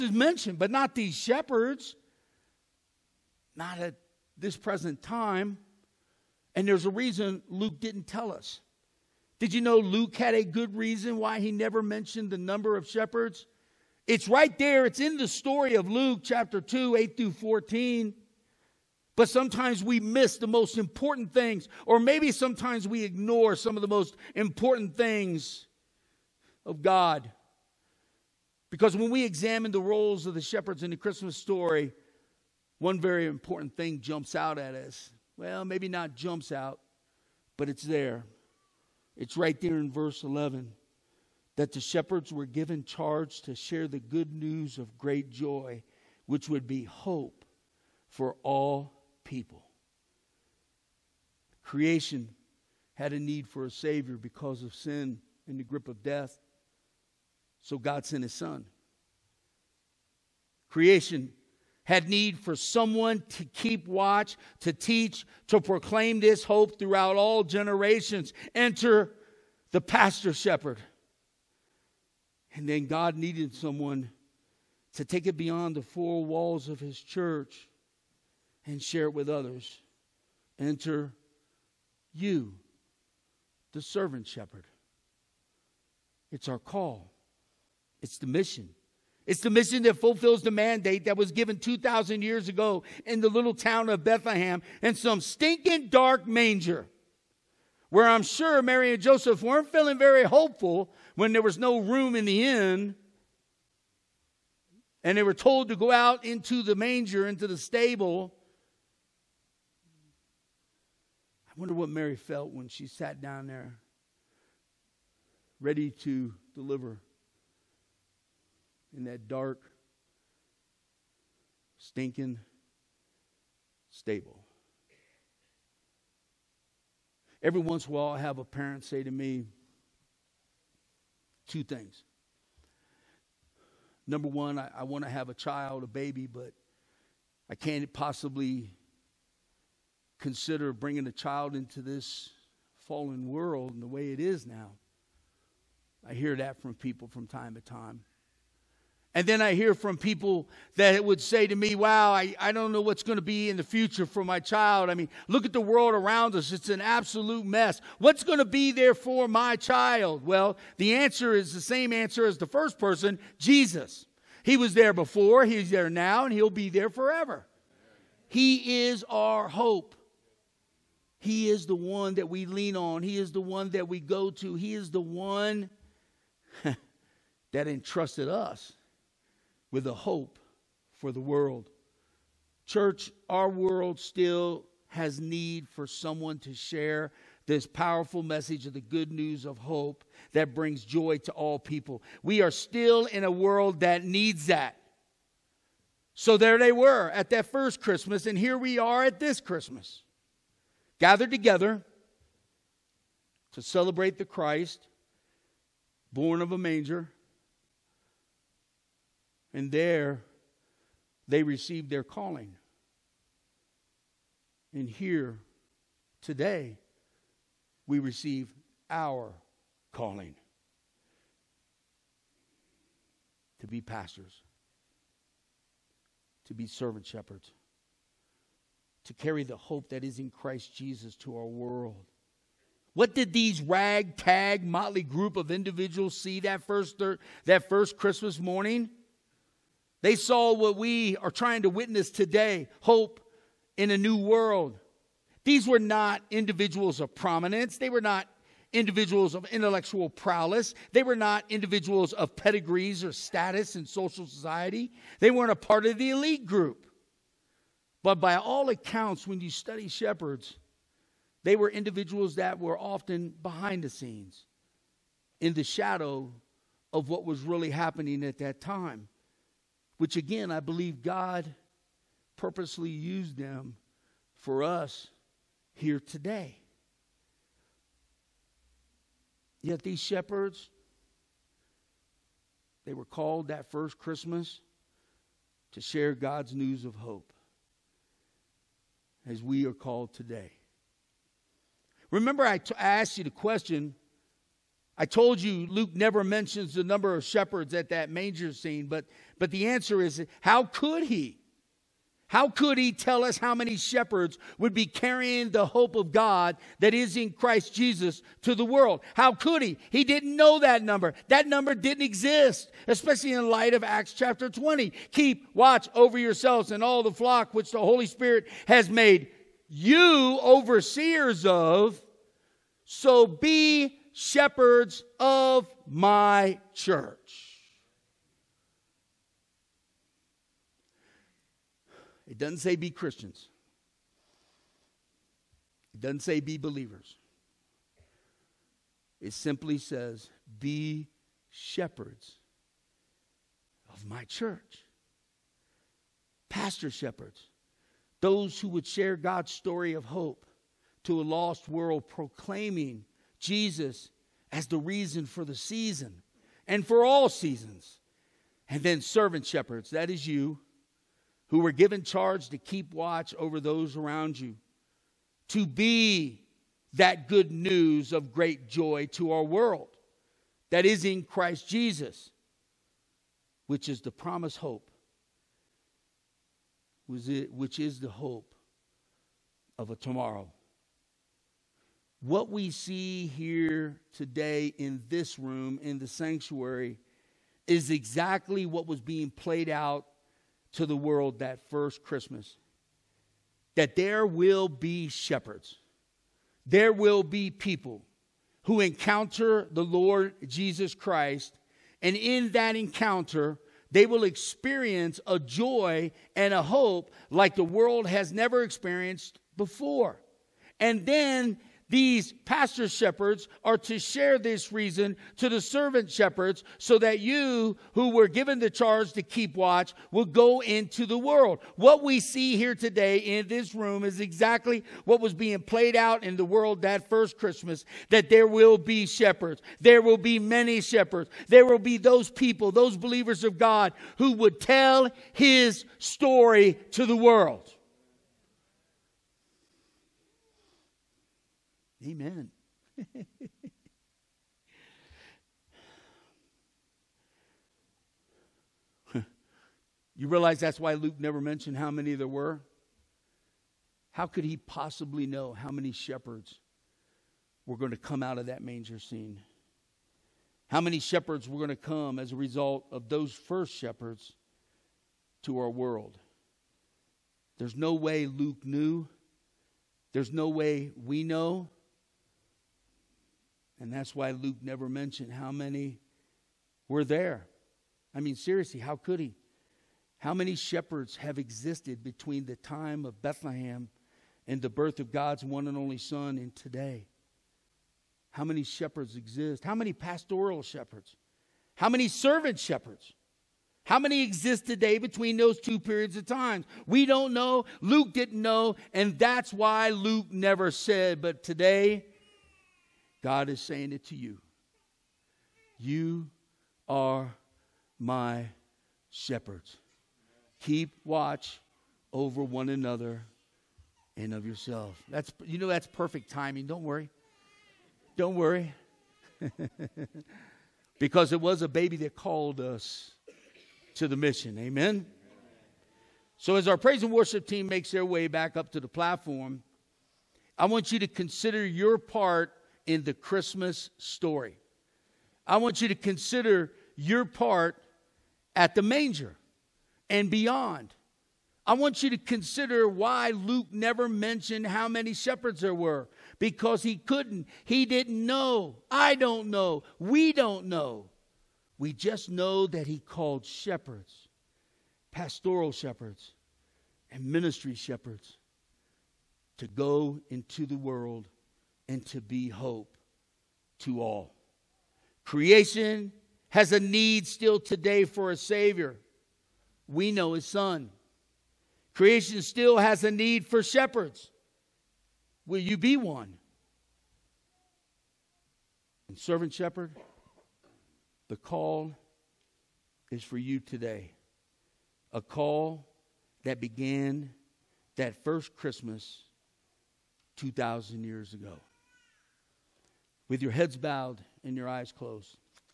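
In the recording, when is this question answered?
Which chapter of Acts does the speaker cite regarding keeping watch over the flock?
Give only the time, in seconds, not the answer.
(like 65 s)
313 s.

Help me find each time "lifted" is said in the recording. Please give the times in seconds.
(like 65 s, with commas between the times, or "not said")
not said.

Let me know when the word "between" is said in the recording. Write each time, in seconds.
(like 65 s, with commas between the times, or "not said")
482 s, 494 s.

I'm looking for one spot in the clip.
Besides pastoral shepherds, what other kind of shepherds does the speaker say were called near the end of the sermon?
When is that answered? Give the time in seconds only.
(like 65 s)
557 s.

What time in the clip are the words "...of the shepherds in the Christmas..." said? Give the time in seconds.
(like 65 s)
30 s.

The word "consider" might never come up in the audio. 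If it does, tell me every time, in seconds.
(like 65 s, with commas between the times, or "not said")
140 s, 531 s, 535 s, 542 s.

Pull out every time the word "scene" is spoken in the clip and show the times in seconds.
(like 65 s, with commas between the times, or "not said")
263 s, 298 s, 458 s.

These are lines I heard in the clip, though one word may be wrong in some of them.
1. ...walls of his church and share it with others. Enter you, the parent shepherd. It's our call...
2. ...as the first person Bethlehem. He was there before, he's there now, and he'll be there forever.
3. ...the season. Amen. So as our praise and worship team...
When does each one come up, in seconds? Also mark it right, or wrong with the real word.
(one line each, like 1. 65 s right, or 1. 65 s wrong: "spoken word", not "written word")
1. 76 s wrong: "servant", not "parent"
2. 162 s wrong: "Jesus", not "Bethlehem"
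3. 524 s wrong: "mission", not "season".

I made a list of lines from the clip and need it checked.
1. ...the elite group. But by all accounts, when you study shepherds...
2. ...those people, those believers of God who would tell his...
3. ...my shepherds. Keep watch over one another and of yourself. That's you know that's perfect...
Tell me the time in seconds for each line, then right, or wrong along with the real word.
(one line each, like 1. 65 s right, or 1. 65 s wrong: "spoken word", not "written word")
1. 255 s right
2. 431 s right
3. 507 s right.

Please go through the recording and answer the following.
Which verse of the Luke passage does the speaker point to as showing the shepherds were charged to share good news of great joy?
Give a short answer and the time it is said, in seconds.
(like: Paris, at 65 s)
Verse 11, at 39 s.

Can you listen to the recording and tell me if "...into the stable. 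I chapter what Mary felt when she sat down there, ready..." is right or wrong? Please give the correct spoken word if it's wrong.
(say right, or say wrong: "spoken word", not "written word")
wrong: "wonder", not "chapter".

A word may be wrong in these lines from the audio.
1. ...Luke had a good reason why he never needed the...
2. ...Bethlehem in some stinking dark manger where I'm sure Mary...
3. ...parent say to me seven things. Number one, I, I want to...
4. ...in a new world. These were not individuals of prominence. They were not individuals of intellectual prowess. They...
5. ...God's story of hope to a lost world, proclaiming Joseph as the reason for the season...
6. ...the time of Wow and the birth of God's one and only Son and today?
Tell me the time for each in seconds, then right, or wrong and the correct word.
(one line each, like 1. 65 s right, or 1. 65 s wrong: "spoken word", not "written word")
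1. 9 s wrong: "mentioned", not "needed"
2. 94 s right
3. 128 s wrong: "two", not "seven"
4. 243 s right
5. 349 s wrong: "Jesus", not "Joseph"
6. 482 s wrong: "Bethlehem", not "Wow".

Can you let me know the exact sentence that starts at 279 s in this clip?
Yet these shepherds, they were called that first Christmas to share God's news of hope as we are called today.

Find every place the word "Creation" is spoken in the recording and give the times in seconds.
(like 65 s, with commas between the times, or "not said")
51 s, 60 s, 565 s, 571 s.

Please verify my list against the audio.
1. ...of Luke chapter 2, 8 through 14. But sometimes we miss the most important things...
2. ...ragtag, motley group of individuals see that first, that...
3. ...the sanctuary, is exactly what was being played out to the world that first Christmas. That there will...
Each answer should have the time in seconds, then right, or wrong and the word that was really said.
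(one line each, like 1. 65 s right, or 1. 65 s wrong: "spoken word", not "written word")
1. 15 s right
2. 233 s right
3. 385 s right.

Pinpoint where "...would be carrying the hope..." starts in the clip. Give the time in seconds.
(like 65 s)
304 s.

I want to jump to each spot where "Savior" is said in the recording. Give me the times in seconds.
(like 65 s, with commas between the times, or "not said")
53 s, 568 s.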